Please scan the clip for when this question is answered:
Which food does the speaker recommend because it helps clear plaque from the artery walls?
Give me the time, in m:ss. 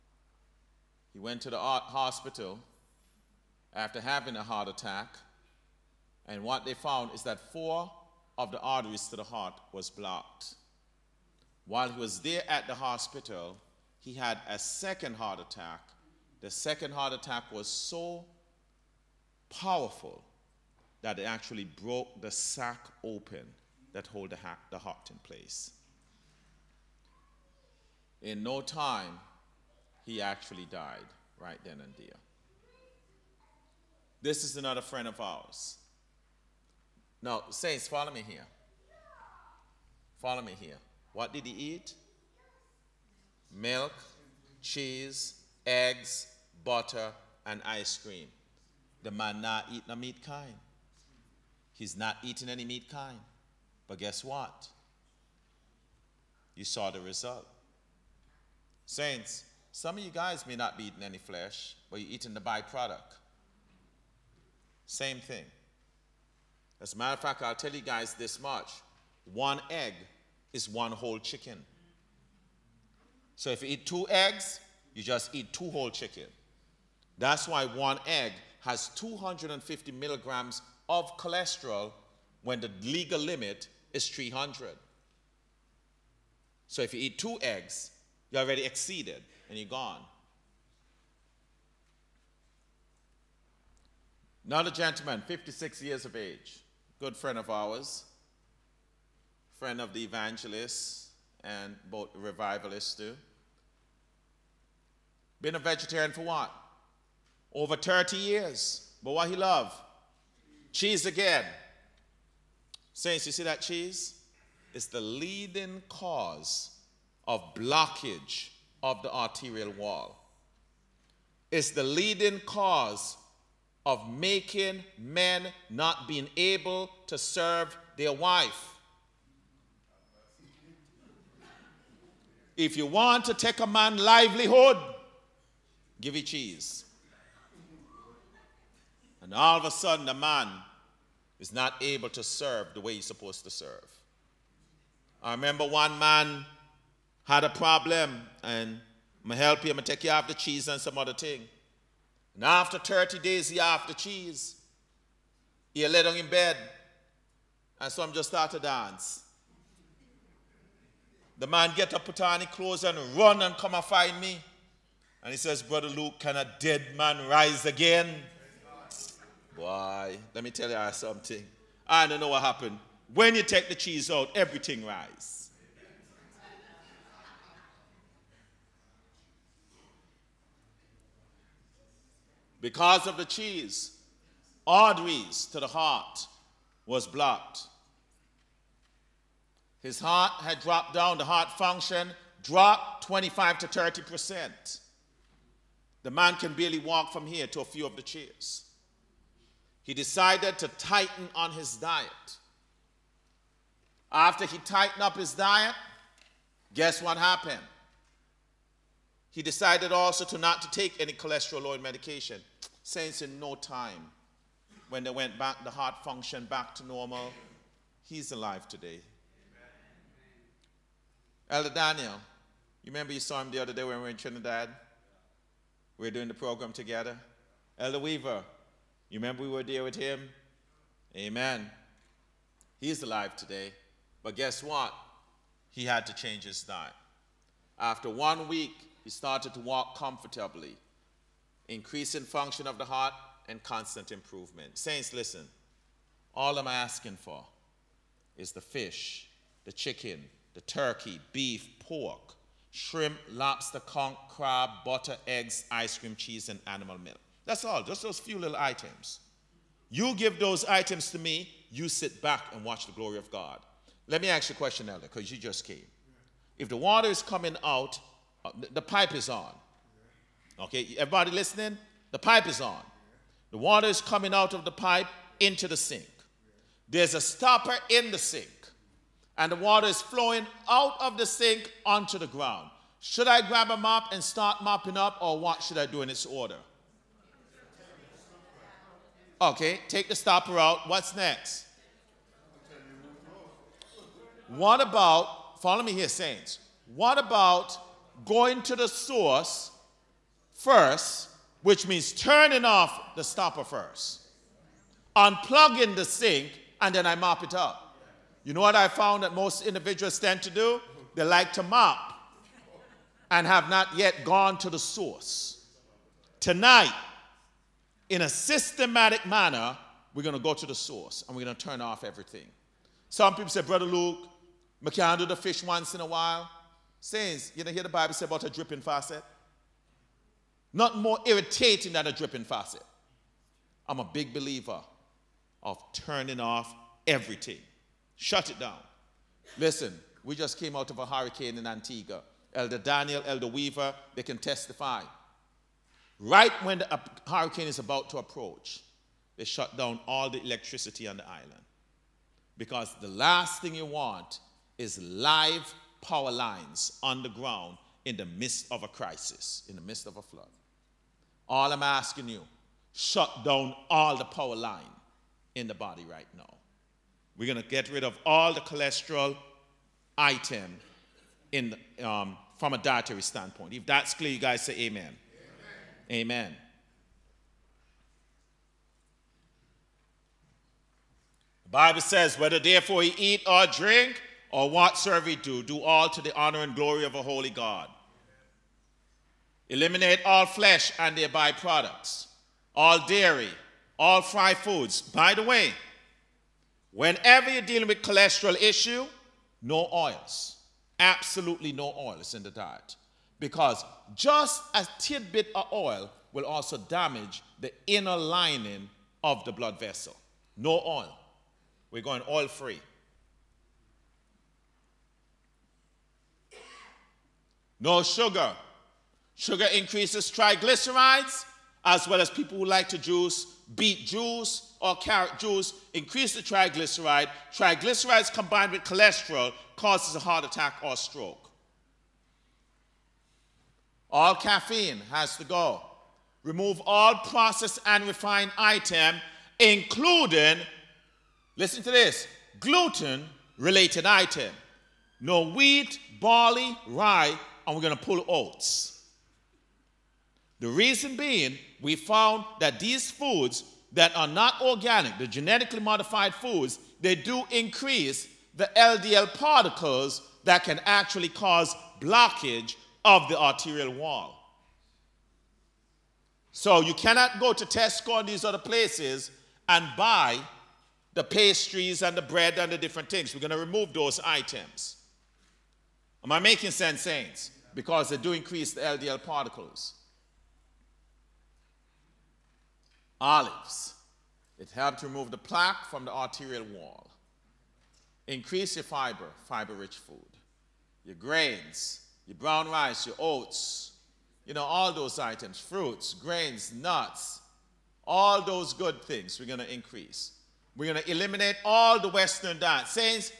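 8:03.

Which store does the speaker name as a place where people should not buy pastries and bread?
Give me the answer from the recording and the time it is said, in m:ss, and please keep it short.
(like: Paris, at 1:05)
Tesco, at 7:47.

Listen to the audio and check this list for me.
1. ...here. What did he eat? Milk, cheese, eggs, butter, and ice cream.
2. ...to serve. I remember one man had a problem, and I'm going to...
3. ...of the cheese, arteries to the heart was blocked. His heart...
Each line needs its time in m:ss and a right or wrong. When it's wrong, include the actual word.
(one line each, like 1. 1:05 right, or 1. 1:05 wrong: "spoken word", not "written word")
1. 0:40 right
2. 2:23 right
3. 3:03 right.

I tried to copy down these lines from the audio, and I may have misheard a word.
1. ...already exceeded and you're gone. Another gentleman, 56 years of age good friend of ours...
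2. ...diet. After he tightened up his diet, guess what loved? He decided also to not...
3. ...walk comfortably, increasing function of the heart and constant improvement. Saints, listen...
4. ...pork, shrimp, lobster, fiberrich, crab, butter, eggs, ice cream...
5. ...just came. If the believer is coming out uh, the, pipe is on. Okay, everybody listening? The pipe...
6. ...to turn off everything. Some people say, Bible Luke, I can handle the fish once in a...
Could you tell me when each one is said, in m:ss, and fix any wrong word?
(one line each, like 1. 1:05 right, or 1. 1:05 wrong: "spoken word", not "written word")
1. 1:28 right
2. 3:21 wrong: "happened", not "loved"
3. 3:59 right
4. 4:11 wrong: "conch", not "fiberrich"
5. 4:25 wrong: "water", not "believer"
6. 5:21 wrong: "Brother", not "Bible".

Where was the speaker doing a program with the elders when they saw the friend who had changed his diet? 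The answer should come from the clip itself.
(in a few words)
Trinidad.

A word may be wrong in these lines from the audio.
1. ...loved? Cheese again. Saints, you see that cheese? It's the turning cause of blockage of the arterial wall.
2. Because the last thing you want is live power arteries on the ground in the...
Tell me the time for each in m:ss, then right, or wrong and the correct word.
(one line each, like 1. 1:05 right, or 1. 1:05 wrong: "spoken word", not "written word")
1. 1:49 wrong: "leading", not "turning"
2. 5:52 wrong: "lines", not "arteries".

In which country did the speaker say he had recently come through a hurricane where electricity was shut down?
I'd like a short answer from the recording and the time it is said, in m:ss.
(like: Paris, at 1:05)
Antigua, at 5:41.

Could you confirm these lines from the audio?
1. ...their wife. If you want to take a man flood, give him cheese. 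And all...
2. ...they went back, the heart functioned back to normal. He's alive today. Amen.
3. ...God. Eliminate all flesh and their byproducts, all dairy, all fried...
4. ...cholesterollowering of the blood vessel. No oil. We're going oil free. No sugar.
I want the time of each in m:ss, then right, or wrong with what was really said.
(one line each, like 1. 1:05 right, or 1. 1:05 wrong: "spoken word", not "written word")
1. 2:07 wrong: "livelihood", not "flood"
2. 3:35 right
3. 6:27 right
4. 6:48 wrong: "lining", not "cholesterollowering".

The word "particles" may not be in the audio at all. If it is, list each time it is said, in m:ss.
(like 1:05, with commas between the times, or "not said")
7:39, 7:59.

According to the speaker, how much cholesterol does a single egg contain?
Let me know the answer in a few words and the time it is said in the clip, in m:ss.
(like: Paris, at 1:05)
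250 milligrams, at 1:18.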